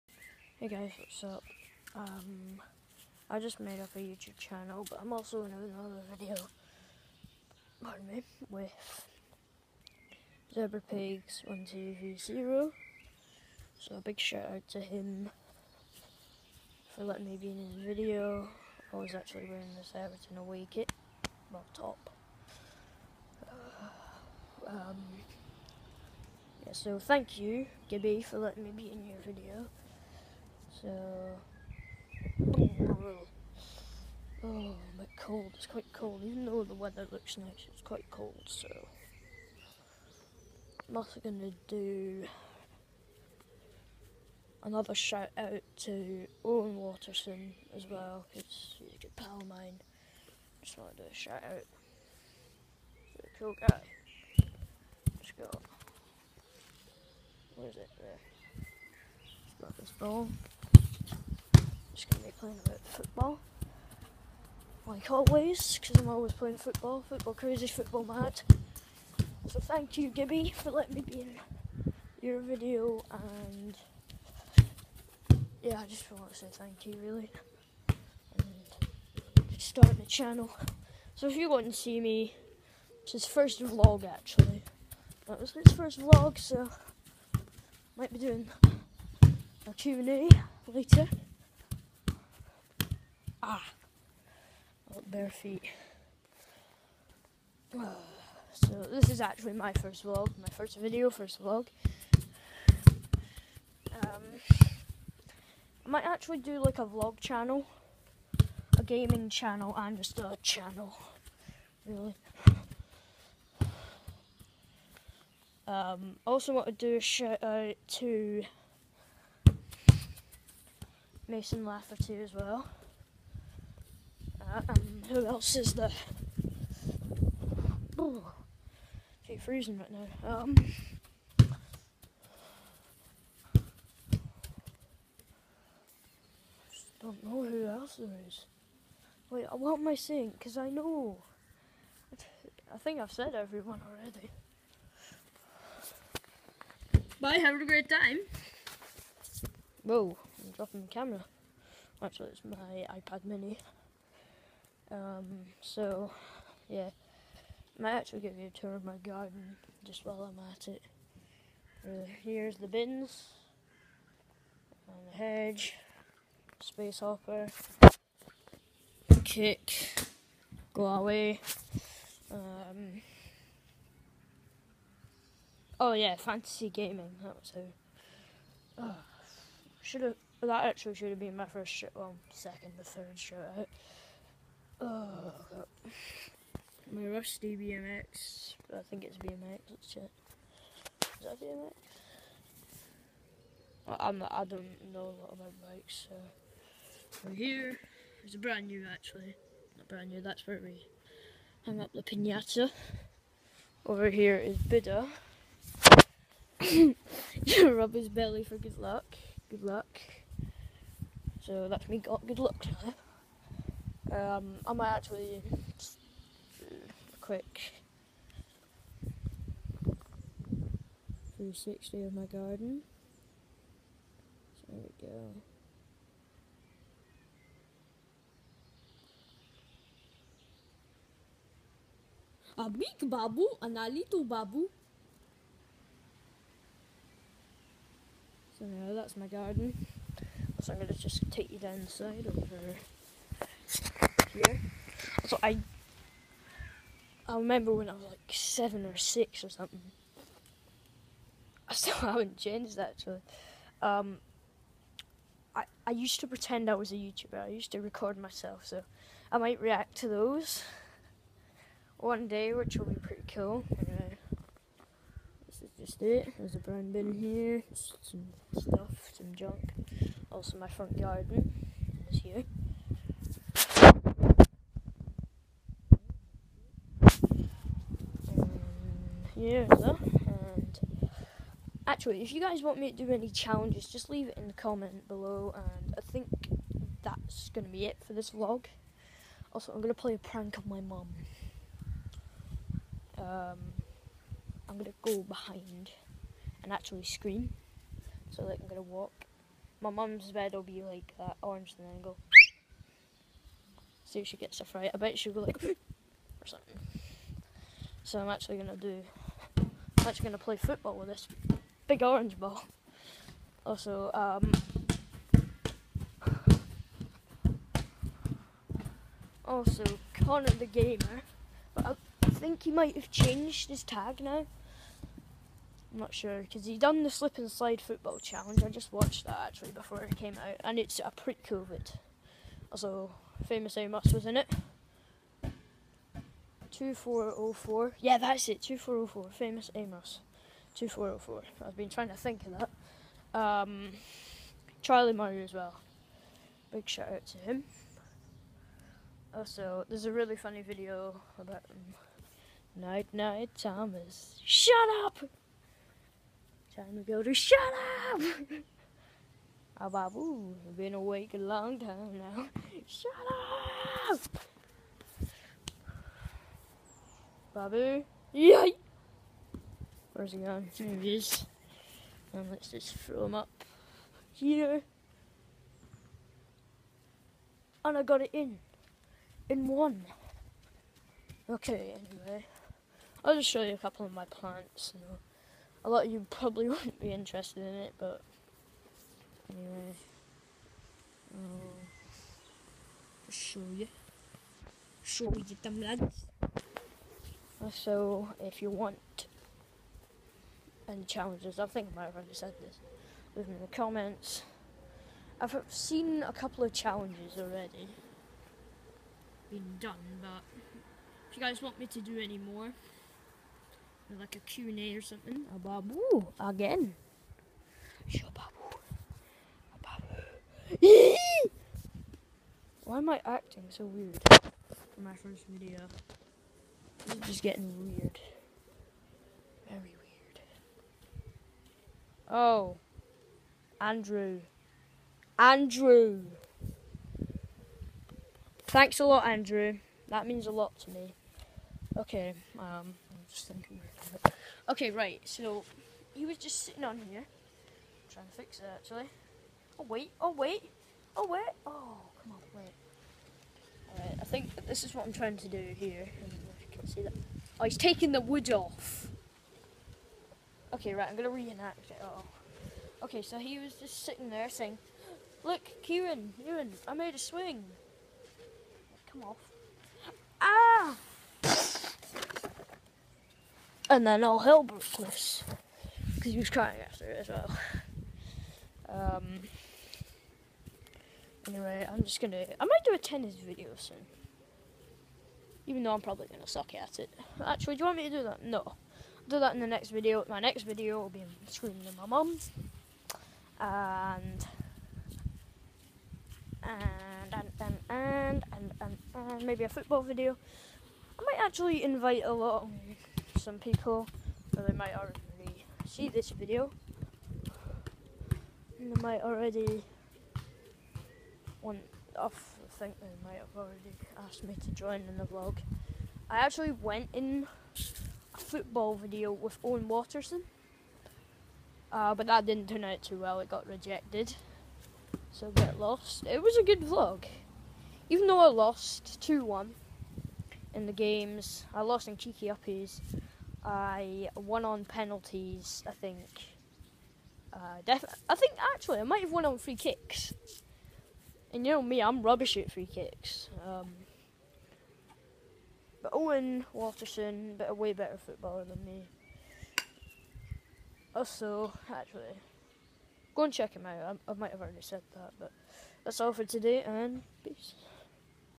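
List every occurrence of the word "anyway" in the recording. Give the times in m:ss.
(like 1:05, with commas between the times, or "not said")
4:23, 6:21, 6:29, 8:01.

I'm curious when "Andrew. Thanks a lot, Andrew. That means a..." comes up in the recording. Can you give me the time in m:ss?
7:15.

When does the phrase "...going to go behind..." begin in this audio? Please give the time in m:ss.
4:54.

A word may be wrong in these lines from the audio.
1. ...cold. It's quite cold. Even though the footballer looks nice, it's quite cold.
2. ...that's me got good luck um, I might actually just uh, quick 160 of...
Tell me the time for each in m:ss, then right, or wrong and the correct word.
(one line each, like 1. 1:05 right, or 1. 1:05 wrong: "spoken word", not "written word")
1. 0:35 wrong: "weather", not "footballer"
2. 3:31 wrong: "360", not "160".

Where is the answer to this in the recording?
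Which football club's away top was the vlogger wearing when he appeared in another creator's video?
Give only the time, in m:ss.
0:19.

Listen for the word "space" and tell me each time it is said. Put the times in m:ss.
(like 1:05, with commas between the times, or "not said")
2:46.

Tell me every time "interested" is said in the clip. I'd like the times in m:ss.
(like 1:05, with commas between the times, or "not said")
6:27.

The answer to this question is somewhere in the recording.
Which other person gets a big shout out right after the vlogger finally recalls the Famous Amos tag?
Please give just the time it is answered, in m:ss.
5:44.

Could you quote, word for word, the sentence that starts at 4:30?
Also, my front garden is here.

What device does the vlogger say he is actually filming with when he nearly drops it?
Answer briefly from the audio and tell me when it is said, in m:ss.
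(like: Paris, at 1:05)
iPad mini, at 2:32.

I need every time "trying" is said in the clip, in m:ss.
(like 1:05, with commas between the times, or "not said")
5:41, 7:28, 7:35.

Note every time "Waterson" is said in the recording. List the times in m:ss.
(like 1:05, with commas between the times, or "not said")
0:46, 8:39, 9:06.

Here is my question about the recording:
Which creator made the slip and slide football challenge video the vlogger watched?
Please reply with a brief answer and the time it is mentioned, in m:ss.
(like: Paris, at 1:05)
Connor the Gamer, at 5:20.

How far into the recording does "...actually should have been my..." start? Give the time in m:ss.
3:00.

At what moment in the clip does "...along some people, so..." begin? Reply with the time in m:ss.
8:22.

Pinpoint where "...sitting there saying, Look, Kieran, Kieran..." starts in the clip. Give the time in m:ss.
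7:44.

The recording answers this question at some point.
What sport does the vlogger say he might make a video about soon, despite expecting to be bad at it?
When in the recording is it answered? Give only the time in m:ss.
8:02.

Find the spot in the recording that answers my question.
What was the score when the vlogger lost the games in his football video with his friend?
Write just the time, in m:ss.
8:49.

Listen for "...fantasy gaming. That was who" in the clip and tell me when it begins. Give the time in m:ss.
2:56.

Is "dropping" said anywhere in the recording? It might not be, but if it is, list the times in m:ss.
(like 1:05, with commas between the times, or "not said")
2:30.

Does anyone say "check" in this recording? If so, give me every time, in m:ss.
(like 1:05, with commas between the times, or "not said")
3:09, 9:13.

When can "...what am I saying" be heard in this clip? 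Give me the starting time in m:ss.
2:19.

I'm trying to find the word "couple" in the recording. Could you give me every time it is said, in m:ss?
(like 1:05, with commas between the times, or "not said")
6:23, 6:46.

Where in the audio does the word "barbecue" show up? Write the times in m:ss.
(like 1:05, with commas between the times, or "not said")
not said.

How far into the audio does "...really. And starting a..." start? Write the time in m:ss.
1:17.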